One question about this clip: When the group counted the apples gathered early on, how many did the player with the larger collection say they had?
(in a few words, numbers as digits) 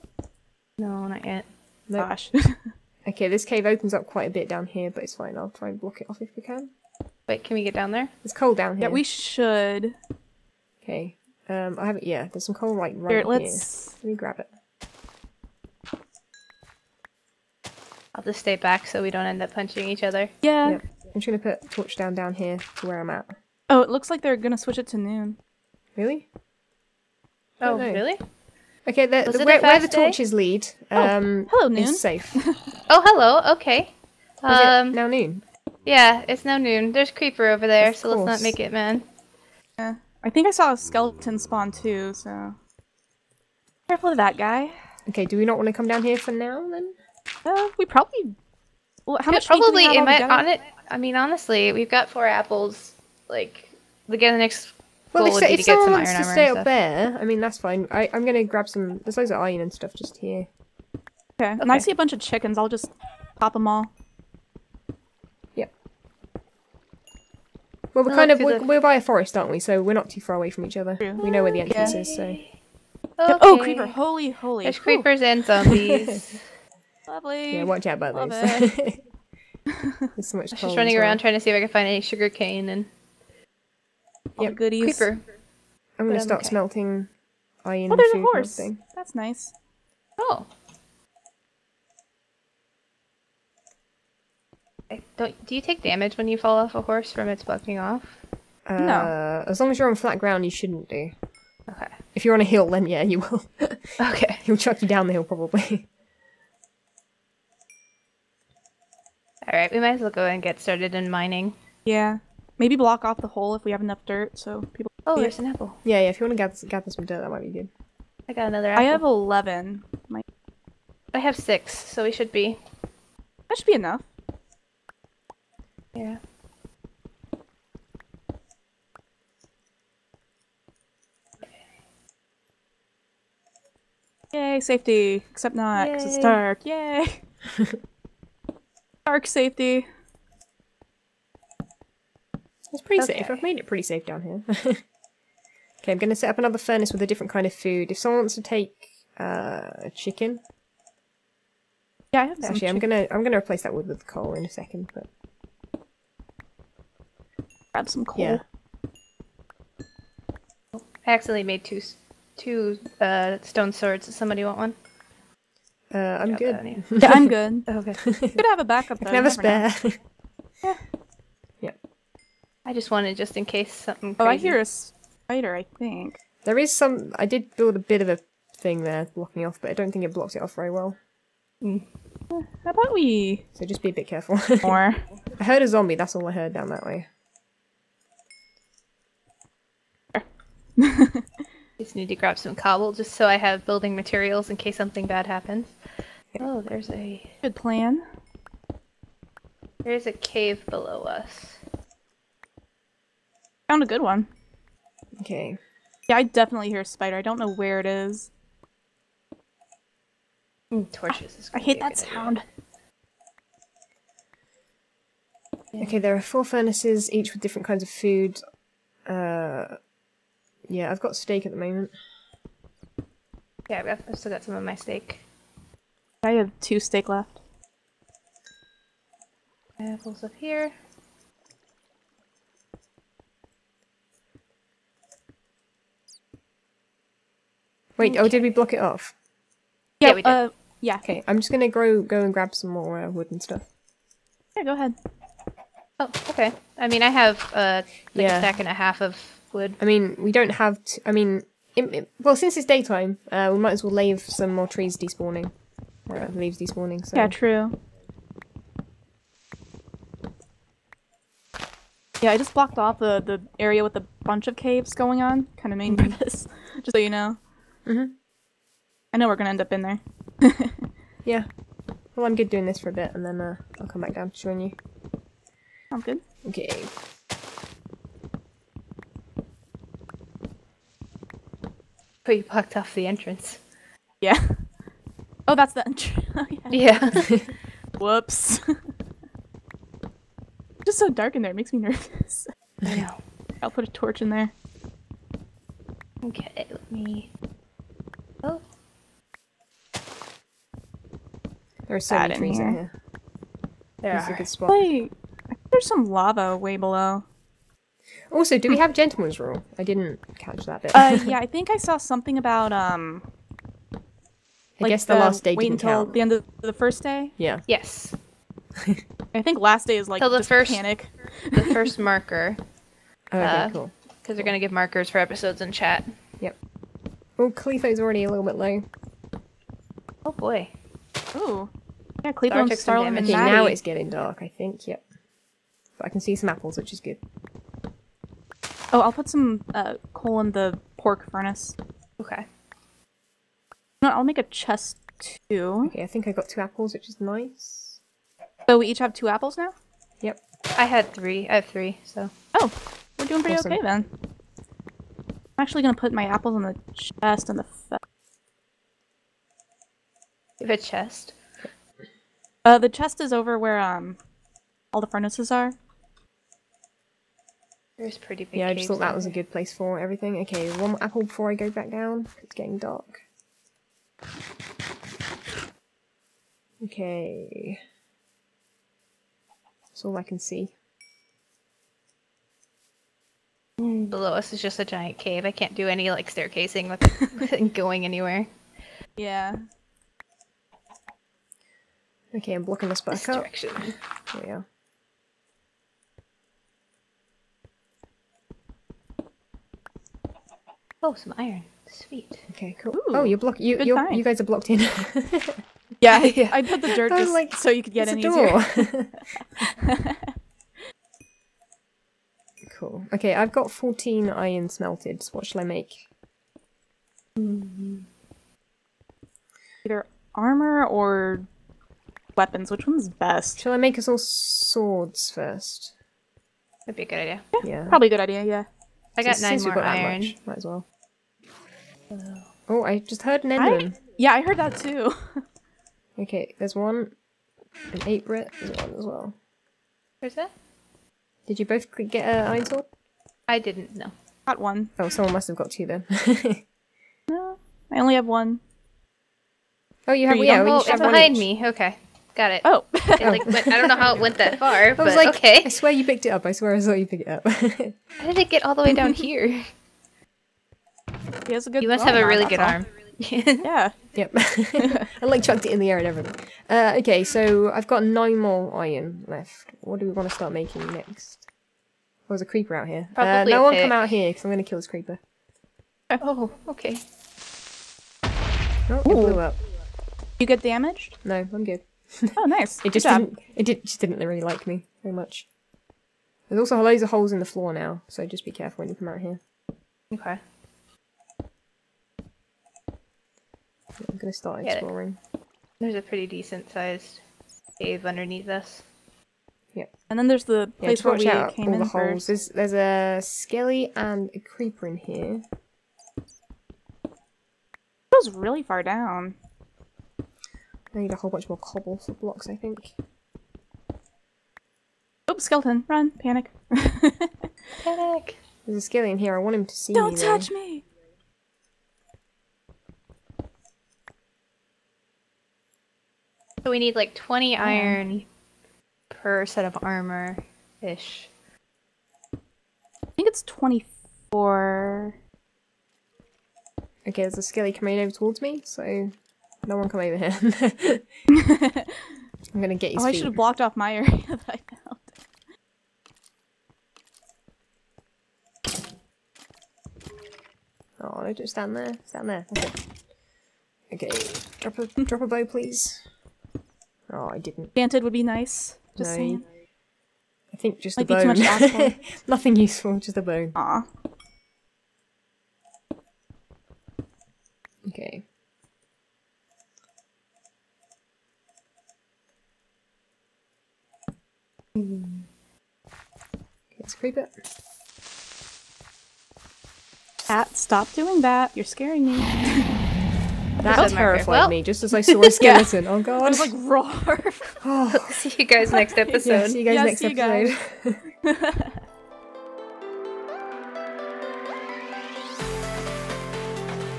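11.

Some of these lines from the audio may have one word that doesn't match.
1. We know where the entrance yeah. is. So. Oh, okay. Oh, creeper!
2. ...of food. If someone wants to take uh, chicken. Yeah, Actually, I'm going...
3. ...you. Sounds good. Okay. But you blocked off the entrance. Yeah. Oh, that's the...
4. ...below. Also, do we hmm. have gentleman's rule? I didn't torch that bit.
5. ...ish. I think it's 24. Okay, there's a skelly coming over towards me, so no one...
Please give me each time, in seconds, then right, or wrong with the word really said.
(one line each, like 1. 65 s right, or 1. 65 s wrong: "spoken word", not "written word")
1. 71 s right
2. 147 s right
3. 274 s right
4. 306 s wrong: "catch", not "torch"
5. 530 s right.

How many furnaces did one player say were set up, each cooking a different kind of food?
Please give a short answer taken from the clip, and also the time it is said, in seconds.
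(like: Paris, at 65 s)
4, at 216 s.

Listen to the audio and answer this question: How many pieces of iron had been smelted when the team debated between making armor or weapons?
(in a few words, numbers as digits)
14.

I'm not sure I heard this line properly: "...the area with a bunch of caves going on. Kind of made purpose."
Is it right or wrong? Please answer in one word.
right.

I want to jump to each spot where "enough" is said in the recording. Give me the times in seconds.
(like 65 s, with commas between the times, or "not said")
113 s, 123 s.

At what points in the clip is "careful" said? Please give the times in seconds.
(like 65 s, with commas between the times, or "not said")
43 s, 184 s, 488 s.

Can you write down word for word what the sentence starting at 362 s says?
Uh, the chest is over where um, all the furnaces are.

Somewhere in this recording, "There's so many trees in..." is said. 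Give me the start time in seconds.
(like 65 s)
301 s.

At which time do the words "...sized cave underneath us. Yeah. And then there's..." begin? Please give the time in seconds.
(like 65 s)
496 s.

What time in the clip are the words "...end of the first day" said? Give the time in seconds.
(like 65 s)
316 s.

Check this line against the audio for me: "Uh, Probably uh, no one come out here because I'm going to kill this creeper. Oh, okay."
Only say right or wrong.
right.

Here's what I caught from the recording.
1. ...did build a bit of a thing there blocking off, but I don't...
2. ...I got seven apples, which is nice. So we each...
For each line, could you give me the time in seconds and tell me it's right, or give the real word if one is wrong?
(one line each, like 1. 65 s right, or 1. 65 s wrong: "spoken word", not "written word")
1. 177 s right
2. 346 s wrong: "two", not "seven".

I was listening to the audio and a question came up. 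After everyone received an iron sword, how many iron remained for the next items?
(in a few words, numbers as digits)
9.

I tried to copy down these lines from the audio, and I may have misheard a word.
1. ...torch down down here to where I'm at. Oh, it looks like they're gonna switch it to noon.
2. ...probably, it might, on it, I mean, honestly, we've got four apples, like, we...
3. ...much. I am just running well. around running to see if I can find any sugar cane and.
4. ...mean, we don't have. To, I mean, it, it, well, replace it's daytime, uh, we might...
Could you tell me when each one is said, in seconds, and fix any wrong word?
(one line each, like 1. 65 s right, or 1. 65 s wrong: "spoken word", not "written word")
1. 21 s right
2. 49 s right
3. 80 s wrong: "trying", not "running"
4. 249 s wrong: "since", not "replace".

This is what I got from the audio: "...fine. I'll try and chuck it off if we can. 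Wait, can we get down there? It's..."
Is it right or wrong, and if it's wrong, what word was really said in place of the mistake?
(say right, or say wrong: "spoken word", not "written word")
wrong: "block", not "chuck".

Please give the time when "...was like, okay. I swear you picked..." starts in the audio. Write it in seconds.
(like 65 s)
454 s.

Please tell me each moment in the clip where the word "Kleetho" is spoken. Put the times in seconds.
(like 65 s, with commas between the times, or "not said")
327 s, 332 s.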